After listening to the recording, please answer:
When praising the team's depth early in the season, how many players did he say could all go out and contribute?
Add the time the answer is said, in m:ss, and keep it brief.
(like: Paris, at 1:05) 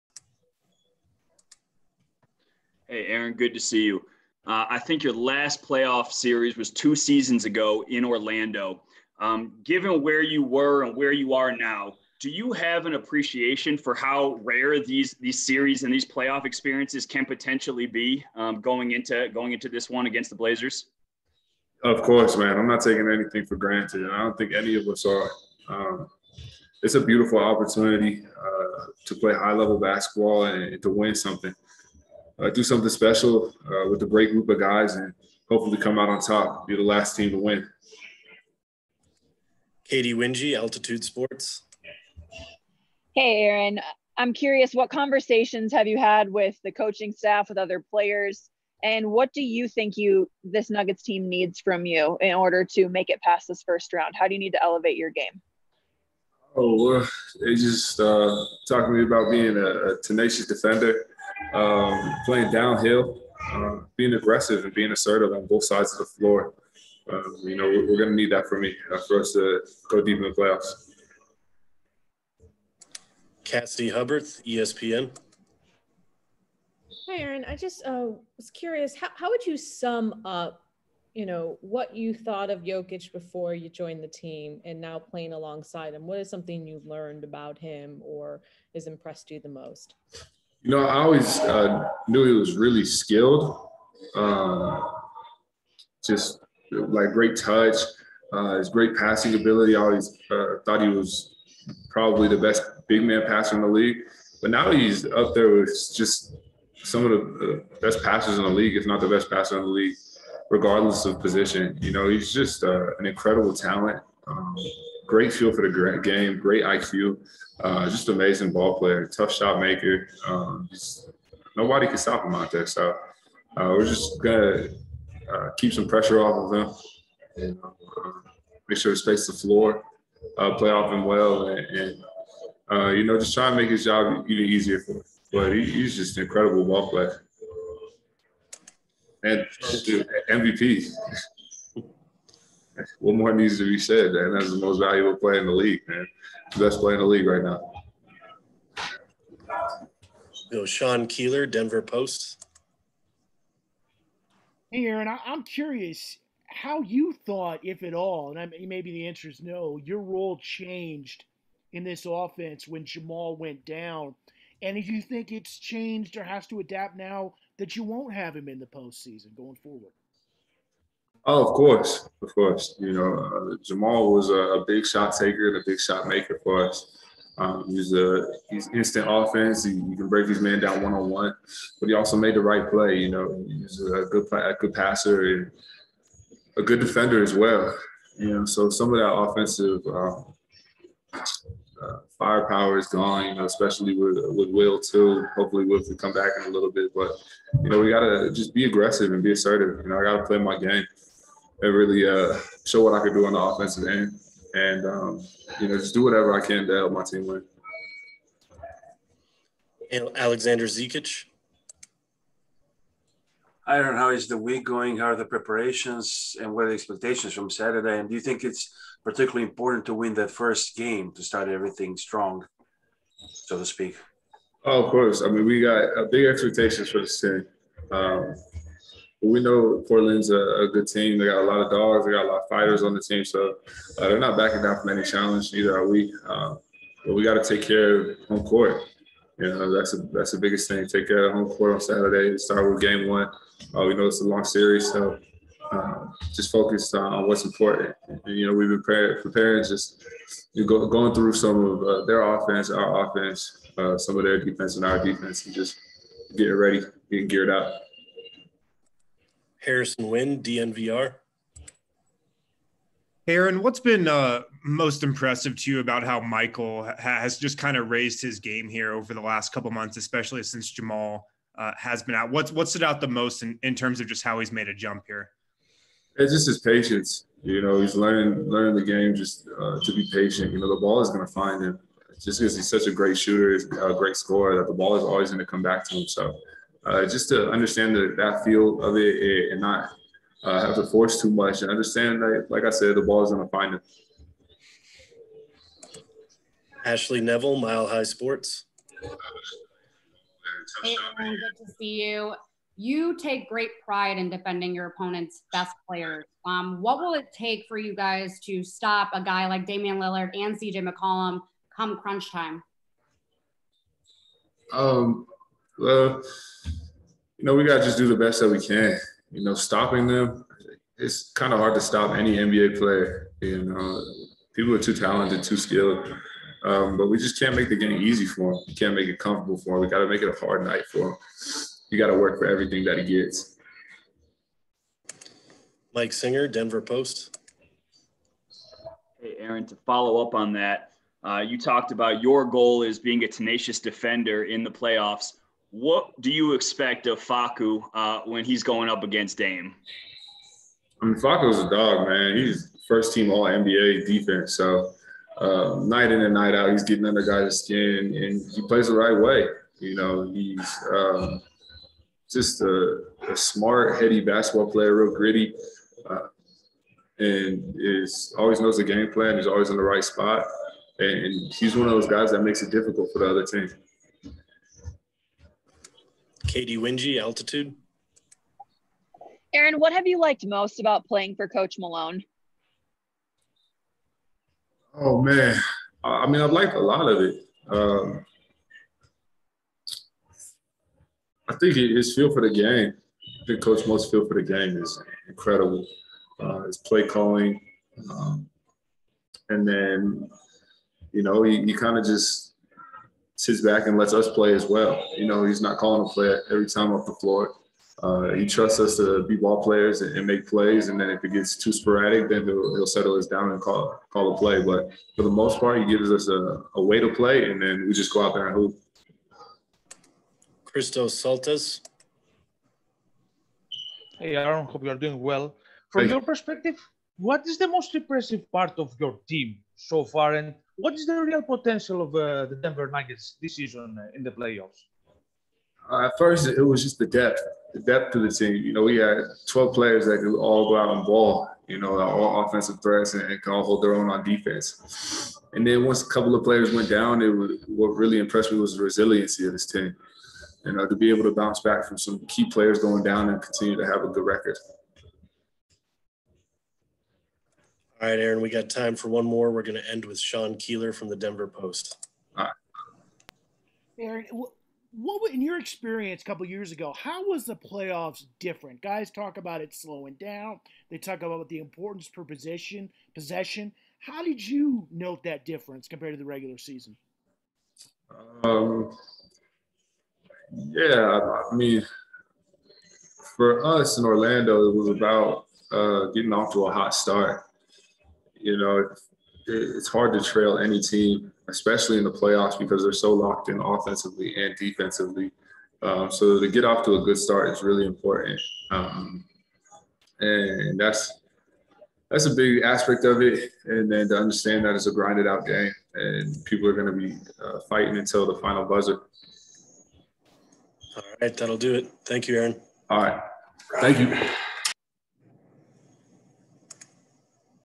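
12, at 7:19.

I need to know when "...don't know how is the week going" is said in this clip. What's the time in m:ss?
3:33.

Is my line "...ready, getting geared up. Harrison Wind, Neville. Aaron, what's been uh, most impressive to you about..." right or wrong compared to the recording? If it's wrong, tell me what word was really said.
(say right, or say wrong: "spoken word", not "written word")
wrong: "DNVR", not "Neville".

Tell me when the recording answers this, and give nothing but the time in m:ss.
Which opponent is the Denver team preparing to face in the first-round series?
0:20.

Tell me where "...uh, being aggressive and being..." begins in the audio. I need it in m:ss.
1:03.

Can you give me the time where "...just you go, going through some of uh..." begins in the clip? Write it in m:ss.
4:09.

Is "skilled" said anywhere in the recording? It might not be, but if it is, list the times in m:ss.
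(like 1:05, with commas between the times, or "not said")
1:32, 5:25.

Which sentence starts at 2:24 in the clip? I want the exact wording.
That's the most valuable player in the league, man.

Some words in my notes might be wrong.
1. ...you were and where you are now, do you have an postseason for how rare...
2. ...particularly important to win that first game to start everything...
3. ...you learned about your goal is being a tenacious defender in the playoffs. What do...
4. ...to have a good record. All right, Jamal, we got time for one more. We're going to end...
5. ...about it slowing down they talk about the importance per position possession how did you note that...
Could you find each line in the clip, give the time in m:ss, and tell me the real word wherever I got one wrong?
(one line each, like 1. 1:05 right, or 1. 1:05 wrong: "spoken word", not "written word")
1. 0:10 wrong: "appreciation", not "postseason"
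2. 3:39 right
3. 5:41 wrong: "talked", not "learned"
4. 7:33 wrong: "Aaron", not "Jamal"
5. 7:49 right.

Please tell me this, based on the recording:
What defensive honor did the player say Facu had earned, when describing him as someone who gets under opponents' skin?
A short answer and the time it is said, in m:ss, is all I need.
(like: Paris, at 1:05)
First team All NBA defense, at 5:52.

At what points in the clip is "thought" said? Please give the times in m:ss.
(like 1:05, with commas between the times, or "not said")
1:22, 1:40, 2:37.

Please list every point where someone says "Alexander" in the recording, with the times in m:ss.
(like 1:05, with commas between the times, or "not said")
3:30.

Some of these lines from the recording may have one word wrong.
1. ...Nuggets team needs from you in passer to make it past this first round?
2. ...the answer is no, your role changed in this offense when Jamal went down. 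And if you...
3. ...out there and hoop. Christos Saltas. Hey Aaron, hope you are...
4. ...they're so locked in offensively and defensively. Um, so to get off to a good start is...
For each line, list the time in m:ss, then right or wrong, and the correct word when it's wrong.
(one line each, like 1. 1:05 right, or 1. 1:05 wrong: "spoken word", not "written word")
1. 0:50 wrong: "order", not "passer"
2. 2:38 right
3. 6:58 right
4. 8:12 right.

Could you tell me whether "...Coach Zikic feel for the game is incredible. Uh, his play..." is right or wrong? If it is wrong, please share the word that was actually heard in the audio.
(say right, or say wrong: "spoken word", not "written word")
wrong: "Most", not "Zikic".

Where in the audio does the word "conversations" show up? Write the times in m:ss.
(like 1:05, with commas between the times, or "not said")
0:44.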